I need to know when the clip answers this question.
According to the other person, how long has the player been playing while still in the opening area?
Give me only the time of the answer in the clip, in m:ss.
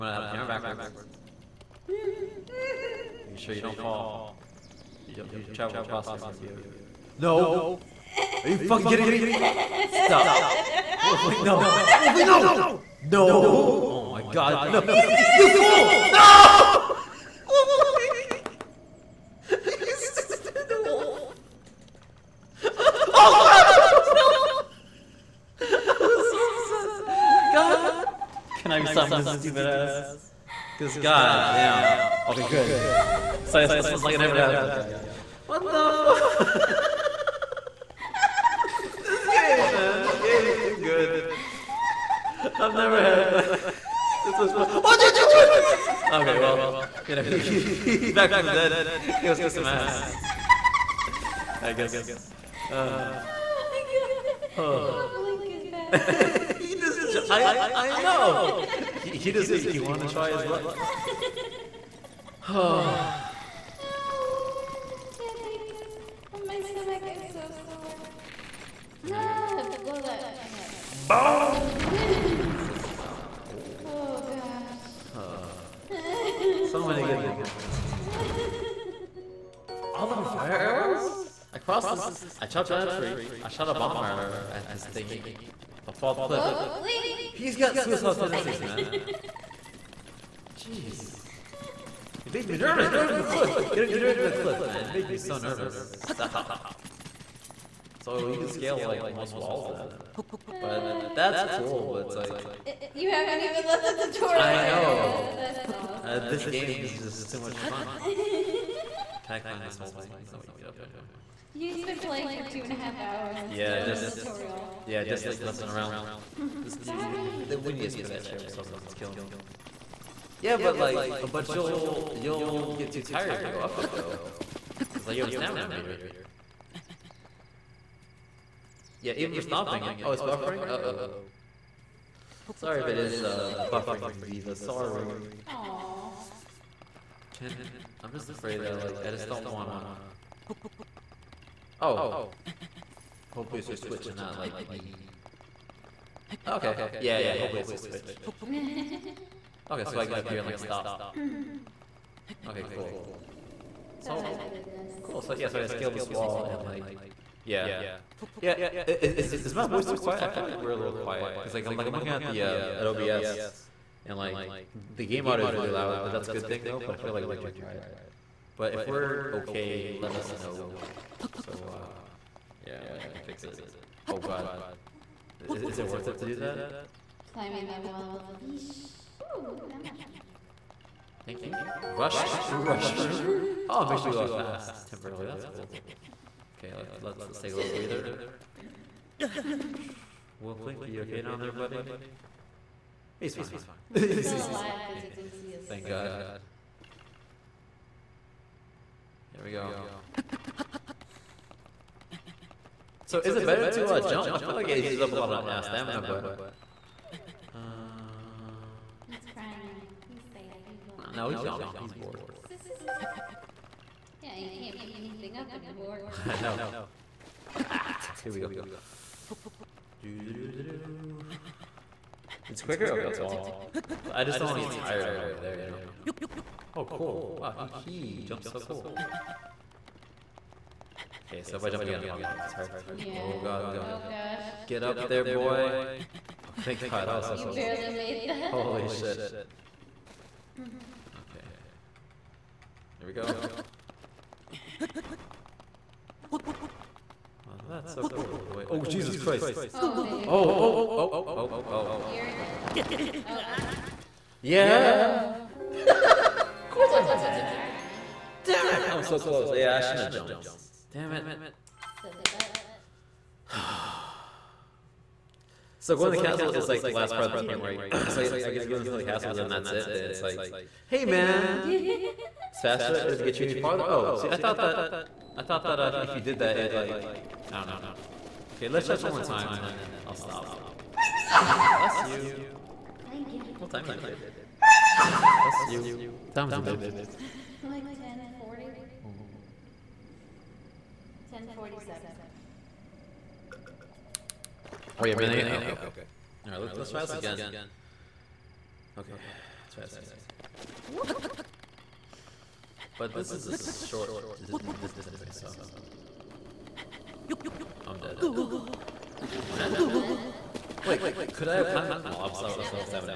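1:52.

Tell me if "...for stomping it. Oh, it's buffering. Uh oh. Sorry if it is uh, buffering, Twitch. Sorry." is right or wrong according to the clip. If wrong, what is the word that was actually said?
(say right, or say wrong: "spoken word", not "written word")
wrong: "Viva", not "Twitch".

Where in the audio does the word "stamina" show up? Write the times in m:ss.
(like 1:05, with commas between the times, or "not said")
2:05, 3:25.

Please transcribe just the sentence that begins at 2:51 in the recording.
So, uh, yeah, like, I can fix it.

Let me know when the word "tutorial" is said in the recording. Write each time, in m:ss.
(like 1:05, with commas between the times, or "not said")
1:44, 1:54.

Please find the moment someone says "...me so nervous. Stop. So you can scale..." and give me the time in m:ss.
1:35.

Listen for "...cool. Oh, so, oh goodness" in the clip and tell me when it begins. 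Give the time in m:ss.
2:32.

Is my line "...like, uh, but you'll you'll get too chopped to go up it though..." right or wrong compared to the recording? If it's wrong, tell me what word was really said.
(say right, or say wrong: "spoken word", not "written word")
wrong: "tired", not "chopped".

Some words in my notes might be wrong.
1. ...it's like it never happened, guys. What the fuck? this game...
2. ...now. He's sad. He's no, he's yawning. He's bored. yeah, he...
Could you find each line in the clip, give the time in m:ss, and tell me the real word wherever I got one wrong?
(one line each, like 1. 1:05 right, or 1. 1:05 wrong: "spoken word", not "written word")
1. 0:33 right
2. 3:29 right.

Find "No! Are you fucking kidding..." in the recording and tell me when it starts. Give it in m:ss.
0:07.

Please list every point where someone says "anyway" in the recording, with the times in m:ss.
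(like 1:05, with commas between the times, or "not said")
1:50, 5:05.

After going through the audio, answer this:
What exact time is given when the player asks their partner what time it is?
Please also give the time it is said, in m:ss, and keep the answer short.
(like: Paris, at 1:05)
10:47, at 4:51.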